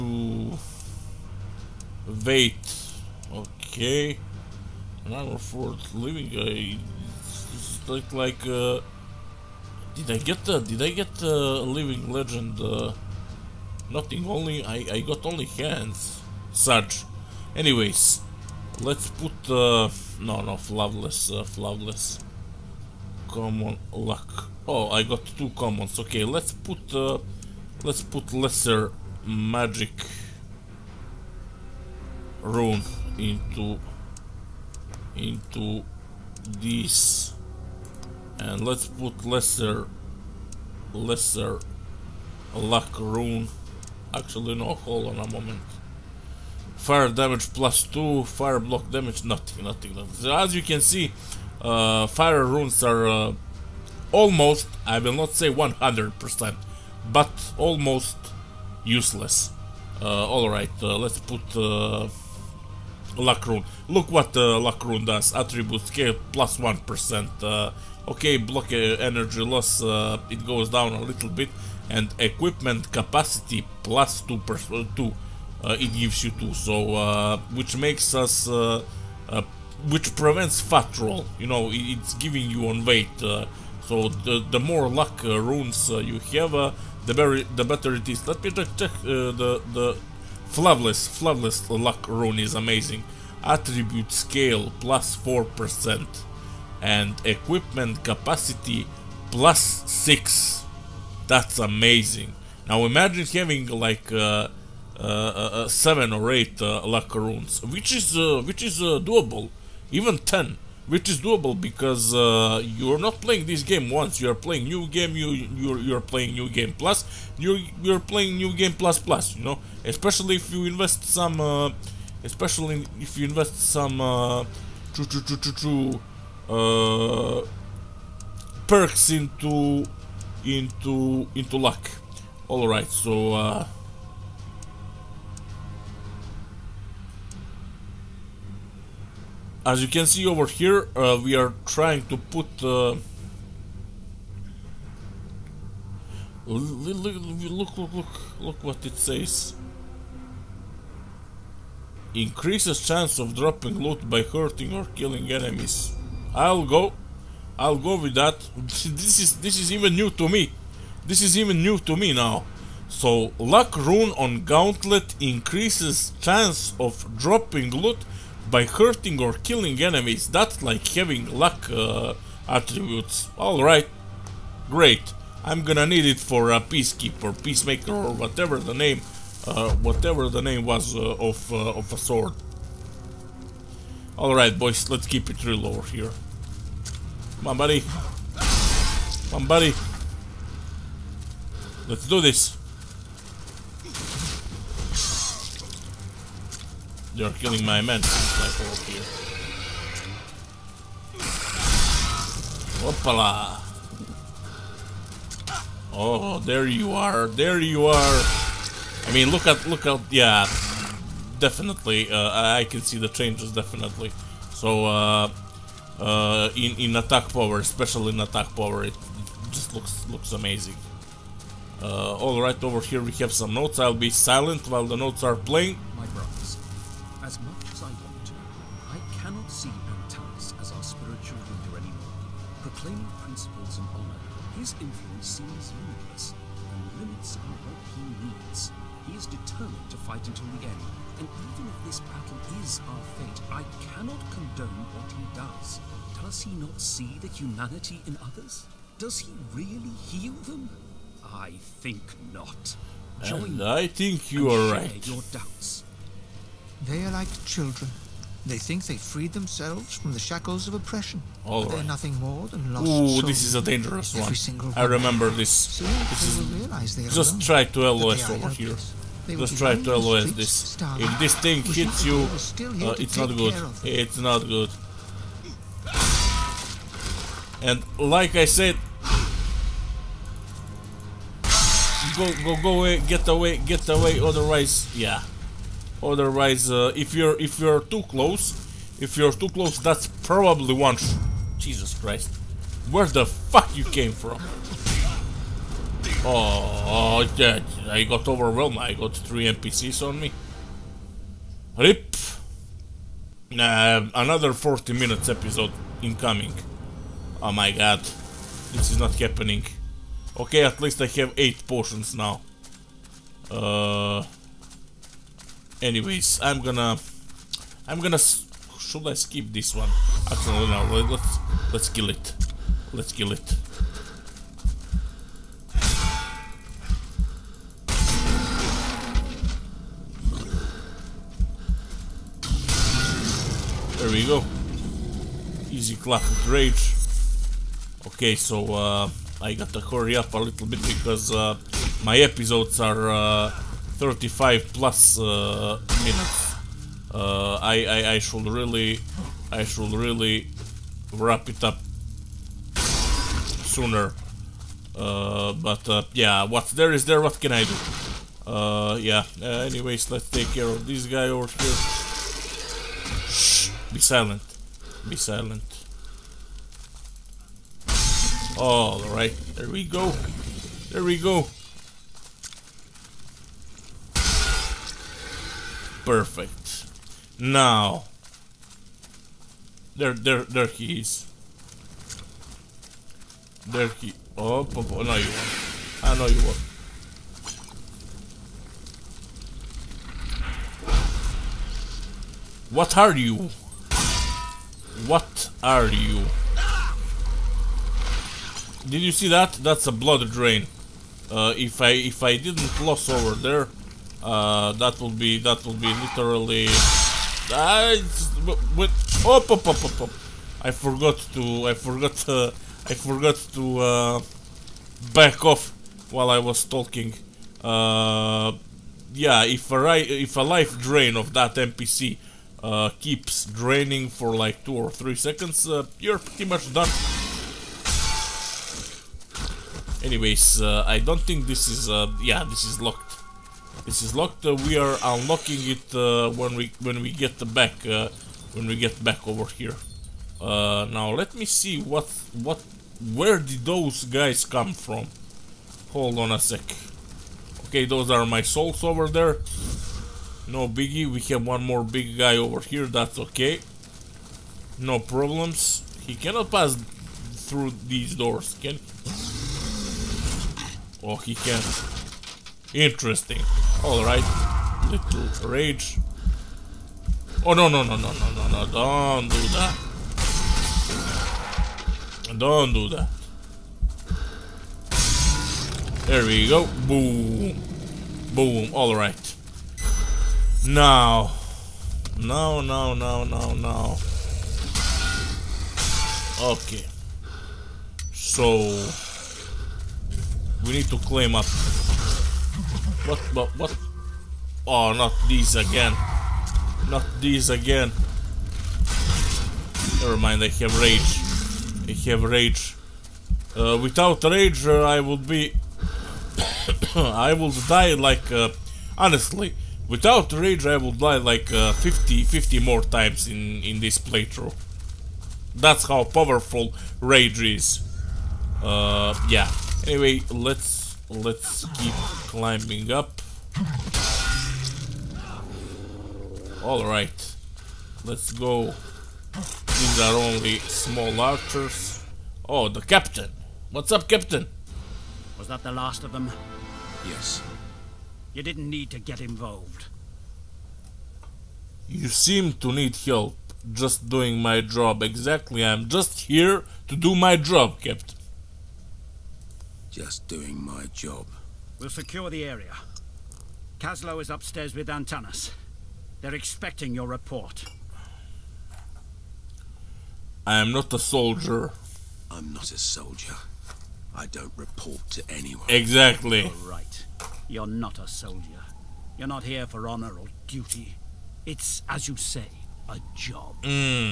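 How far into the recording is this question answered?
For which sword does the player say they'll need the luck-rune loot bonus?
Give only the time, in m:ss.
2:56.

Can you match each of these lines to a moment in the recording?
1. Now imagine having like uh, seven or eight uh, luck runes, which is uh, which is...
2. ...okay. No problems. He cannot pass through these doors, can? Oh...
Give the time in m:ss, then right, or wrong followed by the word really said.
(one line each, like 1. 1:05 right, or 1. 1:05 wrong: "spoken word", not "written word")
1. 1:42 right
2. 7:33 right.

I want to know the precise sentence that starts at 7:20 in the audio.
Uh, now let me see what what where did those guys come from?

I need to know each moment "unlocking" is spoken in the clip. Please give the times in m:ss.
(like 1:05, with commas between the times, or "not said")
7:15.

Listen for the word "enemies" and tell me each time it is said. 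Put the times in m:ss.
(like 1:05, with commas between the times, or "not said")
2:35, 2:49.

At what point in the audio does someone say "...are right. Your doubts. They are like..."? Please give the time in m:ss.
4:14.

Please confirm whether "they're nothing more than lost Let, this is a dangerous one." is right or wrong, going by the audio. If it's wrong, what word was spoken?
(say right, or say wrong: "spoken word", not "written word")
wrong: "Ooh", not "Let".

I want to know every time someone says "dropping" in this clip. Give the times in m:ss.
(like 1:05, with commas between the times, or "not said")
2:33, 2:47.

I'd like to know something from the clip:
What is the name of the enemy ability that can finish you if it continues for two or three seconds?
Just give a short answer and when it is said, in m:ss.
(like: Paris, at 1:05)
Life drain, at 7:00.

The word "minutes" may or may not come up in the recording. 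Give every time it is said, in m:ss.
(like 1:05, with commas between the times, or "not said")
5:04, 5:45.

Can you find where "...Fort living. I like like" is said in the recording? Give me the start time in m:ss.
0:05.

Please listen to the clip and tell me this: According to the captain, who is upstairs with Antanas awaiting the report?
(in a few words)
Kaslo.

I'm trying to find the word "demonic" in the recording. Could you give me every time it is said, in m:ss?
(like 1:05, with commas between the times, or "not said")
not said.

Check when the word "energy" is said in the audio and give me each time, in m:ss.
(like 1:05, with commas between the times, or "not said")
1:08.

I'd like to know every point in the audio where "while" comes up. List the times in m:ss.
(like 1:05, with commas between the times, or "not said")
3:44, 6:56.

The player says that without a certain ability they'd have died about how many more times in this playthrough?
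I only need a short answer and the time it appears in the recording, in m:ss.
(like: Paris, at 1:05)
50, at 8:32.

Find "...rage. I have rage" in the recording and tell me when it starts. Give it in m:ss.
8:20.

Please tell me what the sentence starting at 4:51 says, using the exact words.
Jesus Christ, where the fuck you came from?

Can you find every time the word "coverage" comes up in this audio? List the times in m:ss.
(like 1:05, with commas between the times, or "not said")
not said.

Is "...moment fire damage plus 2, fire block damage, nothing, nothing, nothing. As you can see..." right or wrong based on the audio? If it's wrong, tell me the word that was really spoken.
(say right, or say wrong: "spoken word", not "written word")
right.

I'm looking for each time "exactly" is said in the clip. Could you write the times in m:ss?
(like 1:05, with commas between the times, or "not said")
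9:05, 9:25.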